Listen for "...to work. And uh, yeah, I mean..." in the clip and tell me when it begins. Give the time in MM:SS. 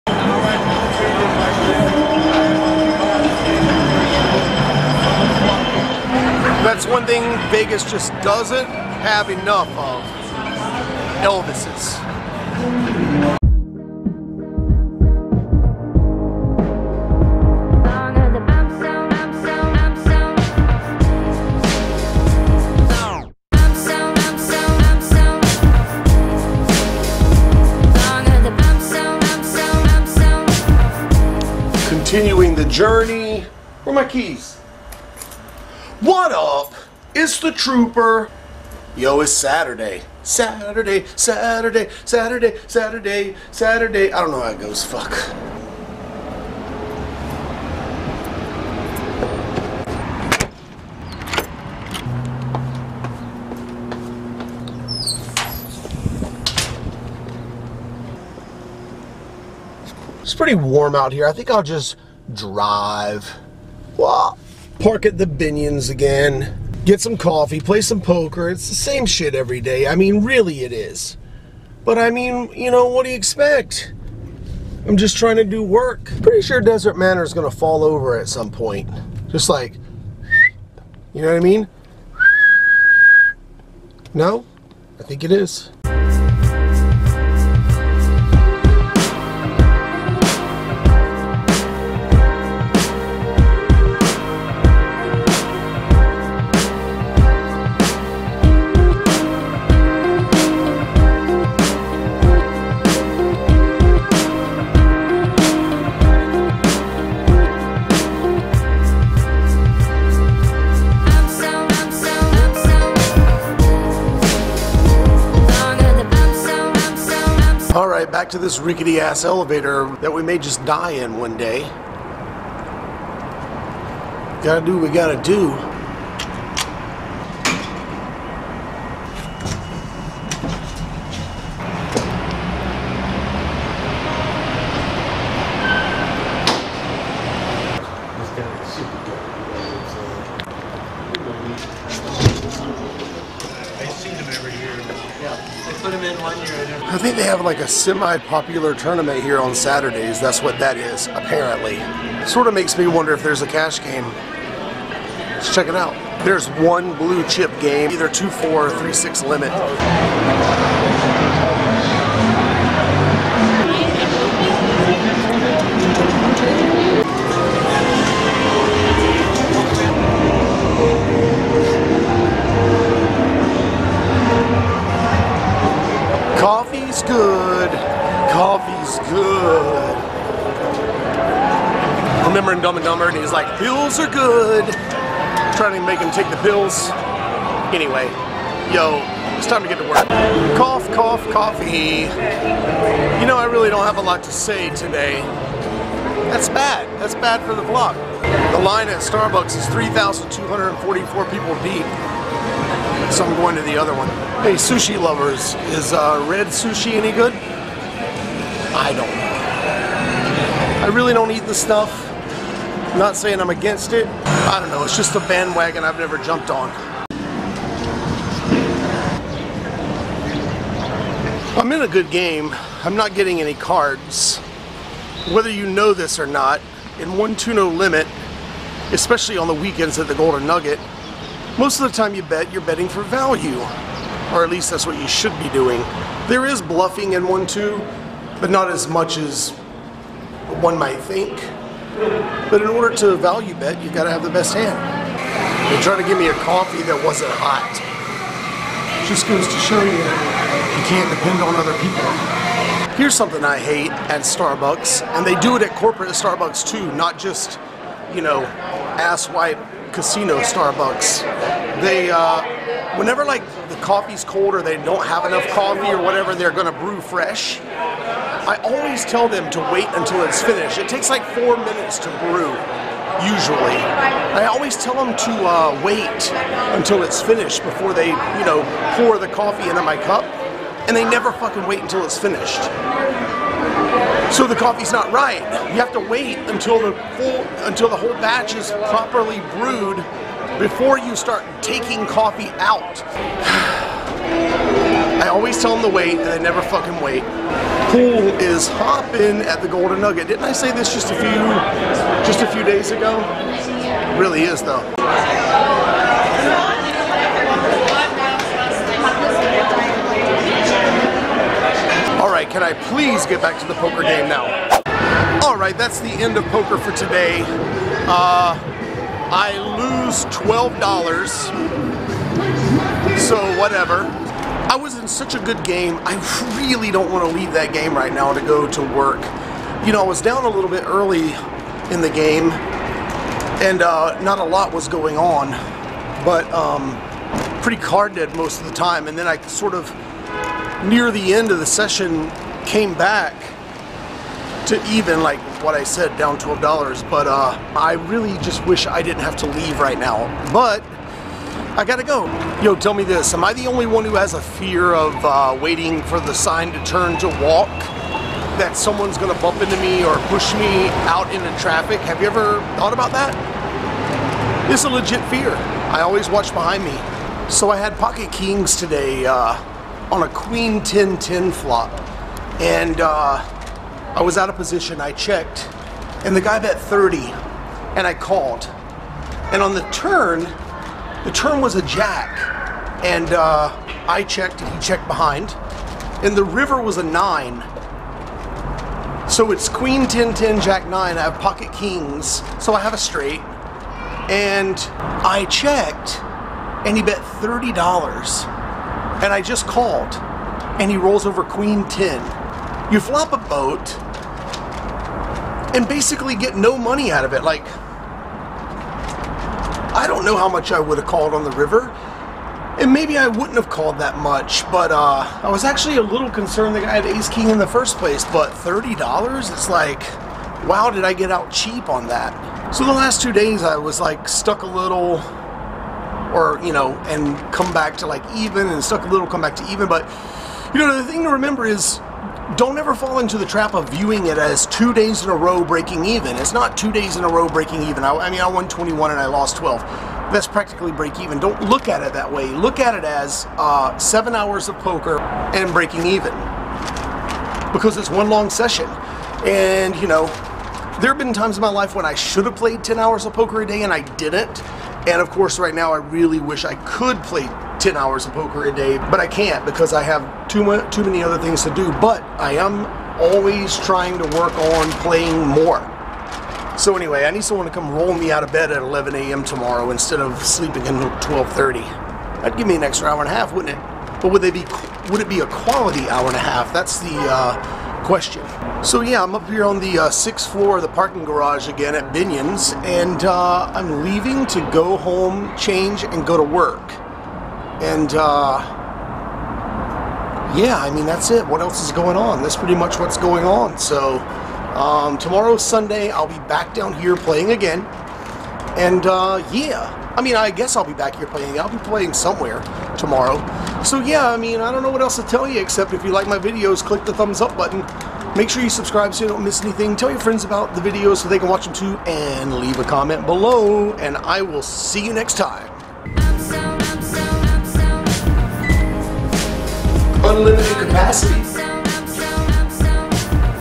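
08:06.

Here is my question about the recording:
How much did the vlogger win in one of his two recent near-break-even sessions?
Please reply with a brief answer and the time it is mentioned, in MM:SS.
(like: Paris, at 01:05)
21, at 07:18.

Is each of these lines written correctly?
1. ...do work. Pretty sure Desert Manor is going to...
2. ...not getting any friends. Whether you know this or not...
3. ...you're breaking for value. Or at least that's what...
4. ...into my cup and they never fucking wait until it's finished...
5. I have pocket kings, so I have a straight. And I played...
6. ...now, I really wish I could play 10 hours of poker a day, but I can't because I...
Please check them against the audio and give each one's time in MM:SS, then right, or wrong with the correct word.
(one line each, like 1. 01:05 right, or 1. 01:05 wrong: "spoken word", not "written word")
1. 01:15 right
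2. 03:42 wrong: "cards", not "friends"
3. 03:52 wrong: "betting", not "breaking"
4. 04:39 right
5. 06:31 wrong: "checked", not "played"
6. 07:35 right.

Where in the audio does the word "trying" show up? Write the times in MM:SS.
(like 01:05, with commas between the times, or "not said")
01:15, 03:05, 07:43.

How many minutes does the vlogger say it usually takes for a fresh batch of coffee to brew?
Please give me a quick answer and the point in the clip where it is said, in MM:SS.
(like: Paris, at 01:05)
4, at 04:31.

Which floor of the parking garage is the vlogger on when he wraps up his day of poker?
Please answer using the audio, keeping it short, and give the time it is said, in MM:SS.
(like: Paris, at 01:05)
sixth floor, at 08:00.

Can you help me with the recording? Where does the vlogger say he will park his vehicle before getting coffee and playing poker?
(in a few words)
Binions.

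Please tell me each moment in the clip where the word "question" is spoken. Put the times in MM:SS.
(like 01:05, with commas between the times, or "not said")
07:58.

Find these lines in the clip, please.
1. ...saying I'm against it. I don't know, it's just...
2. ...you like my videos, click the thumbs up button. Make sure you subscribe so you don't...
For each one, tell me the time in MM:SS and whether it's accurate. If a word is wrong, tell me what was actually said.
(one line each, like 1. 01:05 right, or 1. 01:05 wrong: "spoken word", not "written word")
1. 03:33 right
2. 08:26 right.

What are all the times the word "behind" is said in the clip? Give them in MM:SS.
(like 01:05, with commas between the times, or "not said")
06:06, 06:25.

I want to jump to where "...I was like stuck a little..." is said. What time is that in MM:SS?
07:03.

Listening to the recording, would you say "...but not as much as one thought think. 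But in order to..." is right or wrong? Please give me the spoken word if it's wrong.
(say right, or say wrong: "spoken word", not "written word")
wrong: "might", not "thought".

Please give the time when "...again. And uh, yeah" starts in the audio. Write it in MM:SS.
08:17.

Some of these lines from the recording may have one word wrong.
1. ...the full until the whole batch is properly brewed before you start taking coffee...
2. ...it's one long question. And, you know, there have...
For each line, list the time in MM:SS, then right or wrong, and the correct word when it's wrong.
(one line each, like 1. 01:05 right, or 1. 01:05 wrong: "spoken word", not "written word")
1. 04:46 right
2. 07:27 wrong: "session", not "question".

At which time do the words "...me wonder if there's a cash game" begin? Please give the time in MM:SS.
02:32.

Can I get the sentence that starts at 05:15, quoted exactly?
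Alright, that's the end of poker for today.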